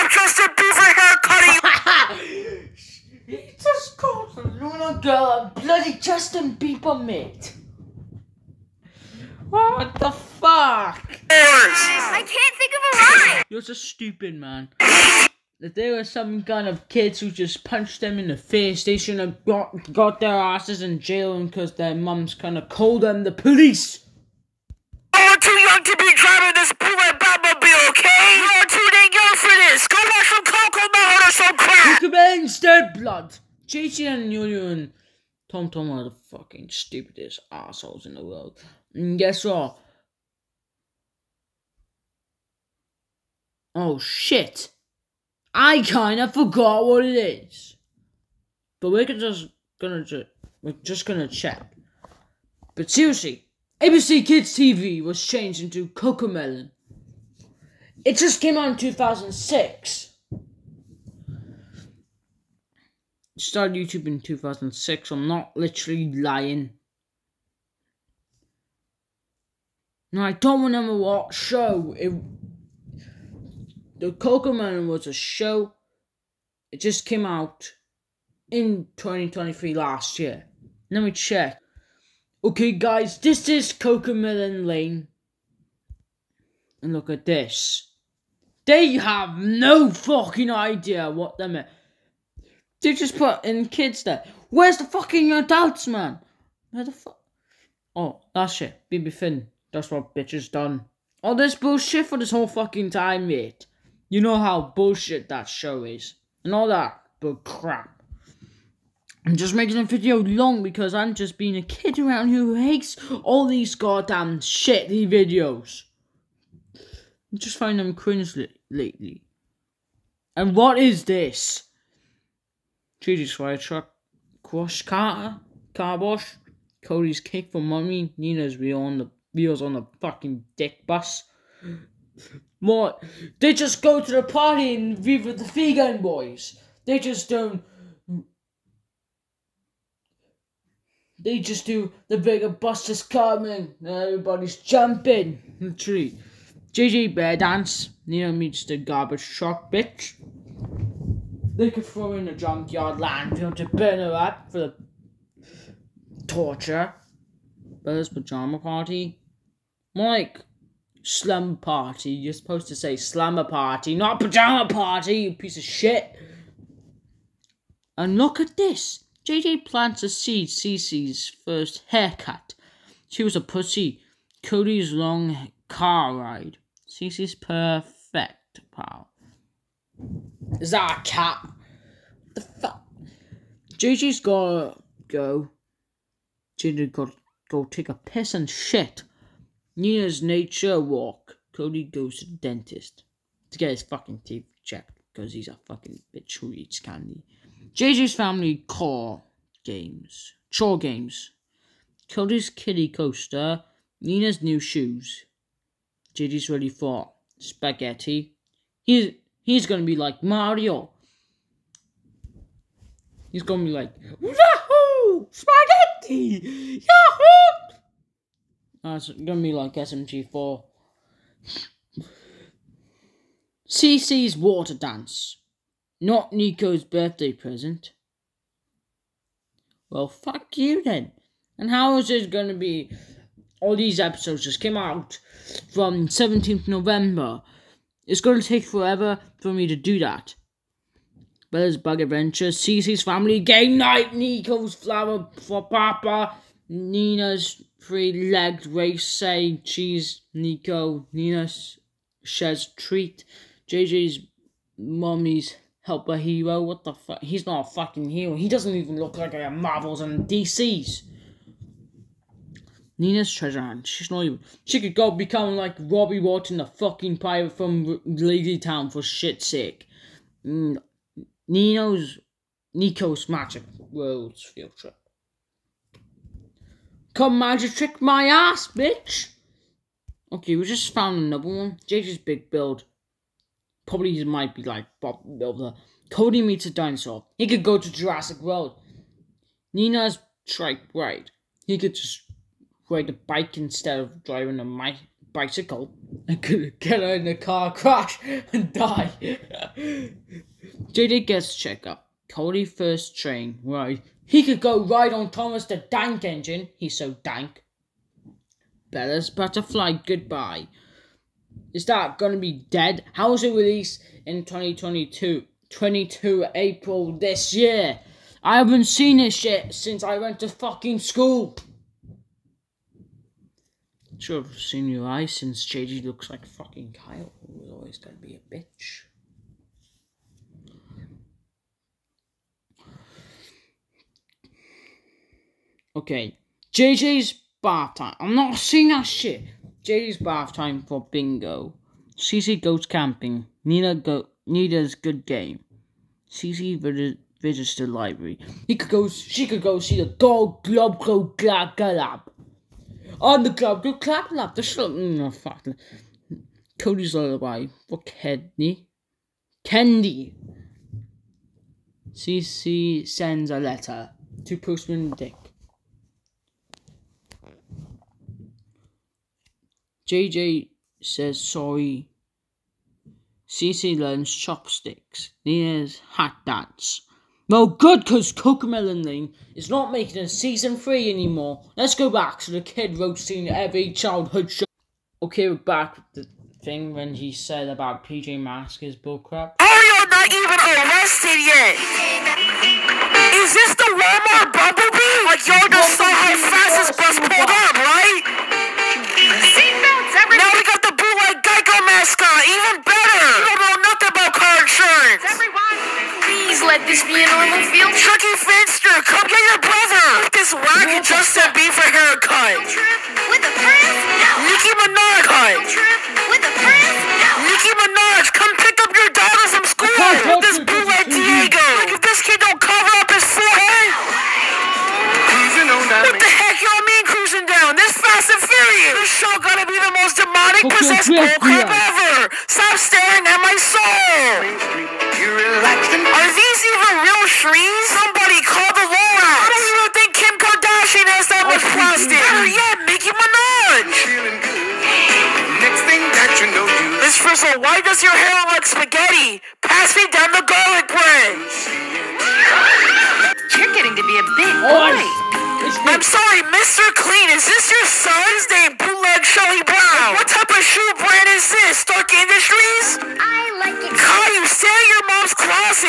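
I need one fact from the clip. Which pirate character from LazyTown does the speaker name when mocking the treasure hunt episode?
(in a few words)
Robbie Watson.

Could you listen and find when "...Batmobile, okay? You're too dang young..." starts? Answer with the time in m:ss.
0:27.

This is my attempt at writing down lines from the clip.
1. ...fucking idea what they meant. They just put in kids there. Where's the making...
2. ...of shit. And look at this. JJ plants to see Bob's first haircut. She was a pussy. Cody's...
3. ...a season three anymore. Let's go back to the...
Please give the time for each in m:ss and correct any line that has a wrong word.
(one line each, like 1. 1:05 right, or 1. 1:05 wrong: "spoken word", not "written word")
1. 1:29 wrong: "fucking", not "making"
2. 2:45 wrong: "Cece", not "Bob"
3. 6:20 right.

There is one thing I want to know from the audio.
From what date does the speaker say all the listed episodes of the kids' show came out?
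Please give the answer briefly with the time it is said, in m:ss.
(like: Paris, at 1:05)
17 November, at 3:56.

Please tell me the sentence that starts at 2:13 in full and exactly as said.
They just go to the party and be with the Vegan Boys.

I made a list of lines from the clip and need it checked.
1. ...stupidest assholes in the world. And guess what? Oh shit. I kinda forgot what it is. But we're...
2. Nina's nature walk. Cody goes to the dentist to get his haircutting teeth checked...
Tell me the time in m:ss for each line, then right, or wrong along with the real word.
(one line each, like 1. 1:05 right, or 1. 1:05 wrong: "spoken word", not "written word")
1. 0:36 right
2. 3:09 wrong: "fucking", not "haircutting".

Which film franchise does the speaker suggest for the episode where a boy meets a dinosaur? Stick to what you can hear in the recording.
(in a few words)
Jurassic World.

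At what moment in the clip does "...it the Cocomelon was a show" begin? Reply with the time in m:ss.
1:11.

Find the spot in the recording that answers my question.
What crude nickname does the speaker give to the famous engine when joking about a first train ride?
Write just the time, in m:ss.
5:05.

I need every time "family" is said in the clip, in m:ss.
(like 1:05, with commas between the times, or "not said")
3:18, 4:03.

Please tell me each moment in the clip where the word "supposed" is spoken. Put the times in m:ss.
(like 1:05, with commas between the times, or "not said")
2:42.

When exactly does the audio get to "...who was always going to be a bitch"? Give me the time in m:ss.
5:27.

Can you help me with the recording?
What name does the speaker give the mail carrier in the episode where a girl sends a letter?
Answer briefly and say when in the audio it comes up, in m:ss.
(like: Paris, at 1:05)
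Postman Dick, at 6:04.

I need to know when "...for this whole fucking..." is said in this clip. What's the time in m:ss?
1:42.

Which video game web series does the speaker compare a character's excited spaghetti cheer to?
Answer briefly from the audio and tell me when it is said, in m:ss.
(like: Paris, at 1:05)
SMG4, at 3:39.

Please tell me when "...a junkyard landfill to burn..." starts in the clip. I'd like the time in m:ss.
2:32.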